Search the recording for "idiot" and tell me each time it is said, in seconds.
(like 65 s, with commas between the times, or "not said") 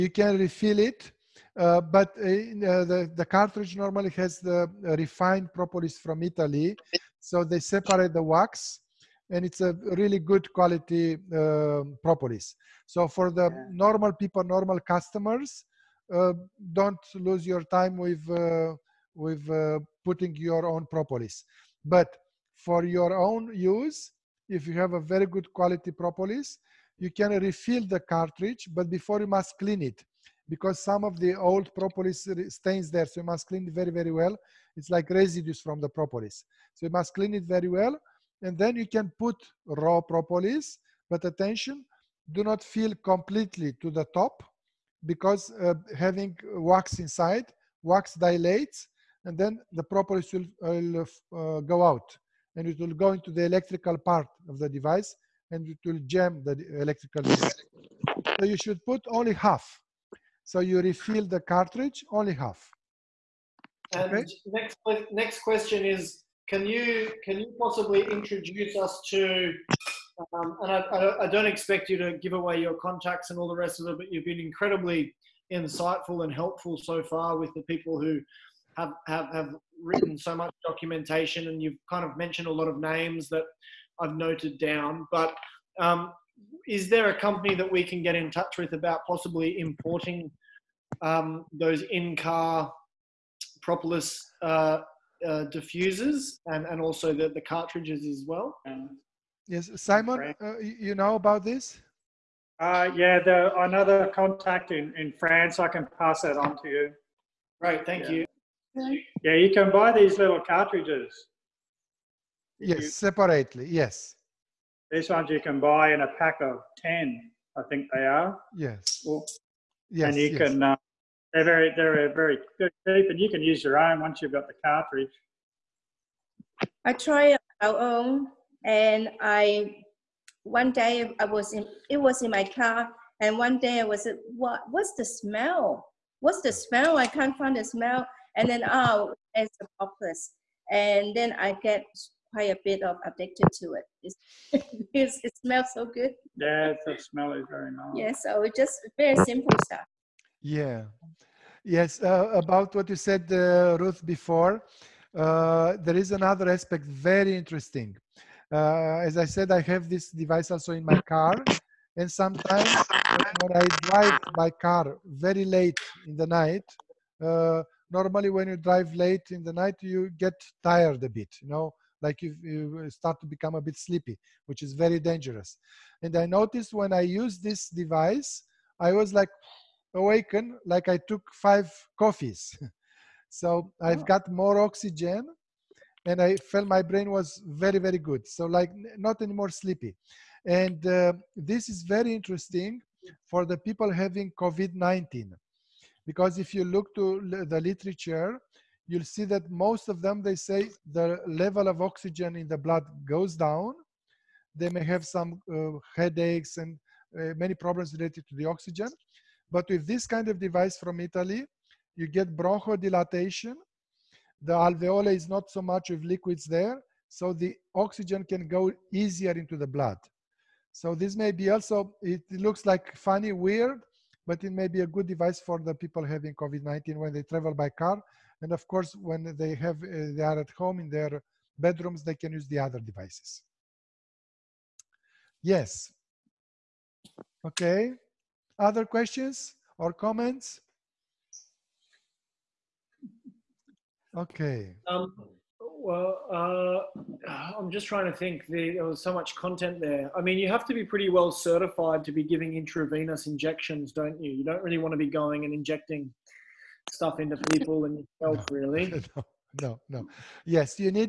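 not said.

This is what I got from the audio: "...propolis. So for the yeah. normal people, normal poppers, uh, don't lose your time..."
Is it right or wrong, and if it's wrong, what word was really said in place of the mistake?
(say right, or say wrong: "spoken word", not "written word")
wrong: "customers", not "poppers".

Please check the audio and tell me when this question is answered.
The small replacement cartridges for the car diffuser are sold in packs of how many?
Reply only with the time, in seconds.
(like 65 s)
116 s.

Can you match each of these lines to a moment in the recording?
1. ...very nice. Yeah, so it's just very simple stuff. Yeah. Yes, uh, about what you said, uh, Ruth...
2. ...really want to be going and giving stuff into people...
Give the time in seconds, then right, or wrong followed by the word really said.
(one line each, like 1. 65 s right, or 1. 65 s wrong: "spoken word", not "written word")
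1. 147 s right
2. 254 s wrong: "injecting", not "giving".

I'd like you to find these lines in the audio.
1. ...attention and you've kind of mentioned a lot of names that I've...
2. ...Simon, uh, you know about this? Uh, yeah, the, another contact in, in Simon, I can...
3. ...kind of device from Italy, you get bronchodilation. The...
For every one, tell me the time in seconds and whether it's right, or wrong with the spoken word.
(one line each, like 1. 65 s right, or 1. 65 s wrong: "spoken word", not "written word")
1. 80 s wrong: "documentation", not "attention"
2. 99 s wrong: "France", not "Simon"
3. 210 s right.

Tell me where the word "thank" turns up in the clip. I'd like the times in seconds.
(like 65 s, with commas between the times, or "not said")
107 s.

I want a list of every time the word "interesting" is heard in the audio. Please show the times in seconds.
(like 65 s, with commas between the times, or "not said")
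157 s, 192 s.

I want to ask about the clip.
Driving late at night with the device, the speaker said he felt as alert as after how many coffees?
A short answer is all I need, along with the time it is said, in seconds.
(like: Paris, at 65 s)
5, at 181 s.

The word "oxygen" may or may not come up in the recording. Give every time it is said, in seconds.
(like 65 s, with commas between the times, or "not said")
184 s, 201 s, 208 s, 217 s.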